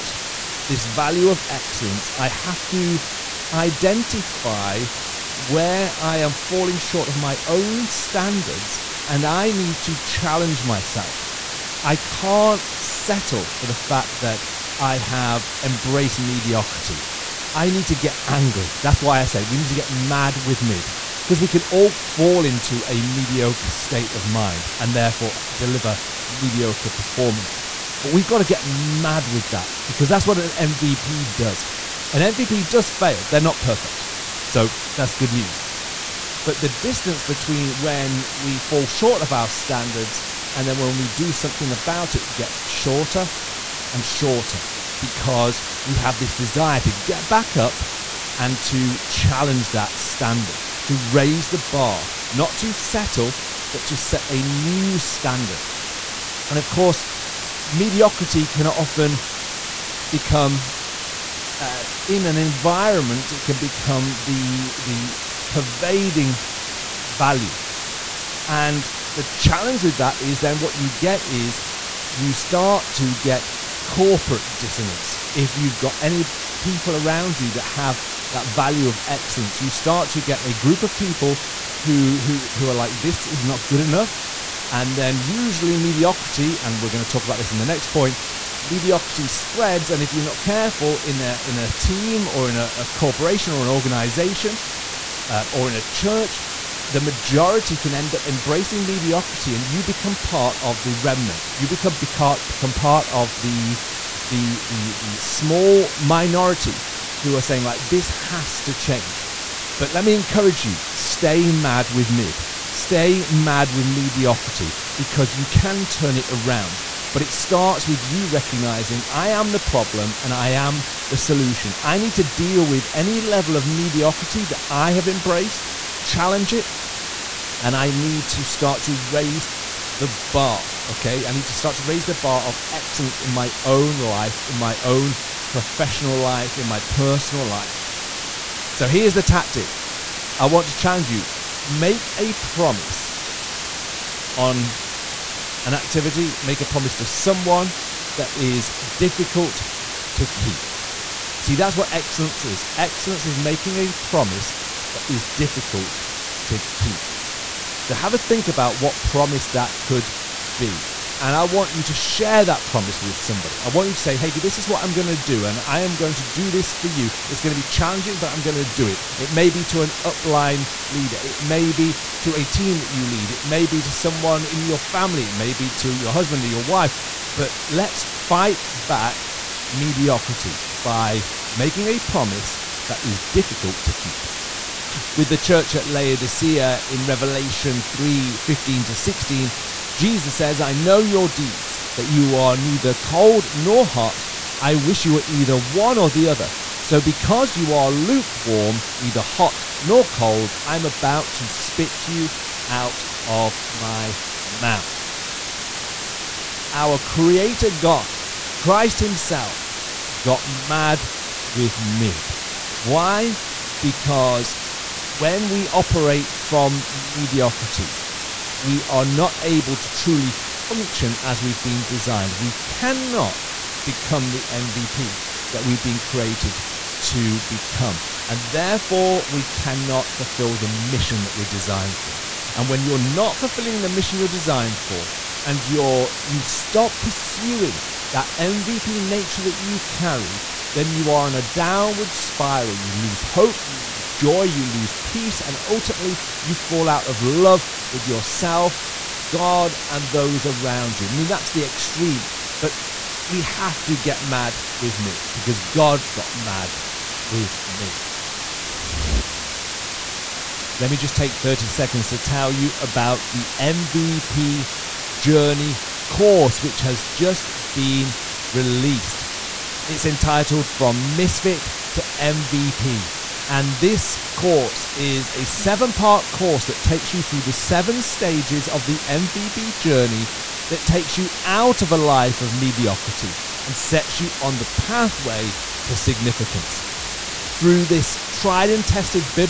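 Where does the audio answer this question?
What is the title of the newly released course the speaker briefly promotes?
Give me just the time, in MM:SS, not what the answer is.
04:30.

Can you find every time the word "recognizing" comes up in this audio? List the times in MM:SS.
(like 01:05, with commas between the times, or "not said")
01:58.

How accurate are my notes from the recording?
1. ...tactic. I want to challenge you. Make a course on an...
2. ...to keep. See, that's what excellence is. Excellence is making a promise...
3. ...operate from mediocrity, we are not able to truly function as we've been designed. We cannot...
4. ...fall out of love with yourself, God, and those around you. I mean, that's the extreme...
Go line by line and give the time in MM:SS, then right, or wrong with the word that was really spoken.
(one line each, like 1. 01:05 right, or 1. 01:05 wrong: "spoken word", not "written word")
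1. 02:19 wrong: "promise", not "course"
2. 02:30 right
3. 03:35 right
4. 04:06 right.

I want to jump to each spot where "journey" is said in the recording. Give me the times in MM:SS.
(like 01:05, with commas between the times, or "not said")
04:25, 04:39.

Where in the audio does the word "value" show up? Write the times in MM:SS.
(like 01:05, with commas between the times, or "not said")
00:00, 01:07, 01:18.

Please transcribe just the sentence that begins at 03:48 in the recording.
And therefore, we cannot fulfill the mission that we're designed for.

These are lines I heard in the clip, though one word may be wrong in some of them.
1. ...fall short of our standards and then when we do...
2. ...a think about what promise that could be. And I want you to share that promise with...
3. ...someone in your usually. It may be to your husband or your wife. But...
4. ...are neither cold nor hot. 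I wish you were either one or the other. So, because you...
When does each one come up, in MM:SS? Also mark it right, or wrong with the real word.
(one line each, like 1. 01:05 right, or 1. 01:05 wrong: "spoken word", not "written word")
1. 00:38 right
2. 02:38 right
3. 02:53 wrong: "family", not "usually"
4. 03:12 right.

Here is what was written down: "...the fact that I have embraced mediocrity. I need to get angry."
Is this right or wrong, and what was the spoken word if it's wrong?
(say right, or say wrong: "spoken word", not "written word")
right.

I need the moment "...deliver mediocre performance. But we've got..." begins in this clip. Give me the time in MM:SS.
00:25.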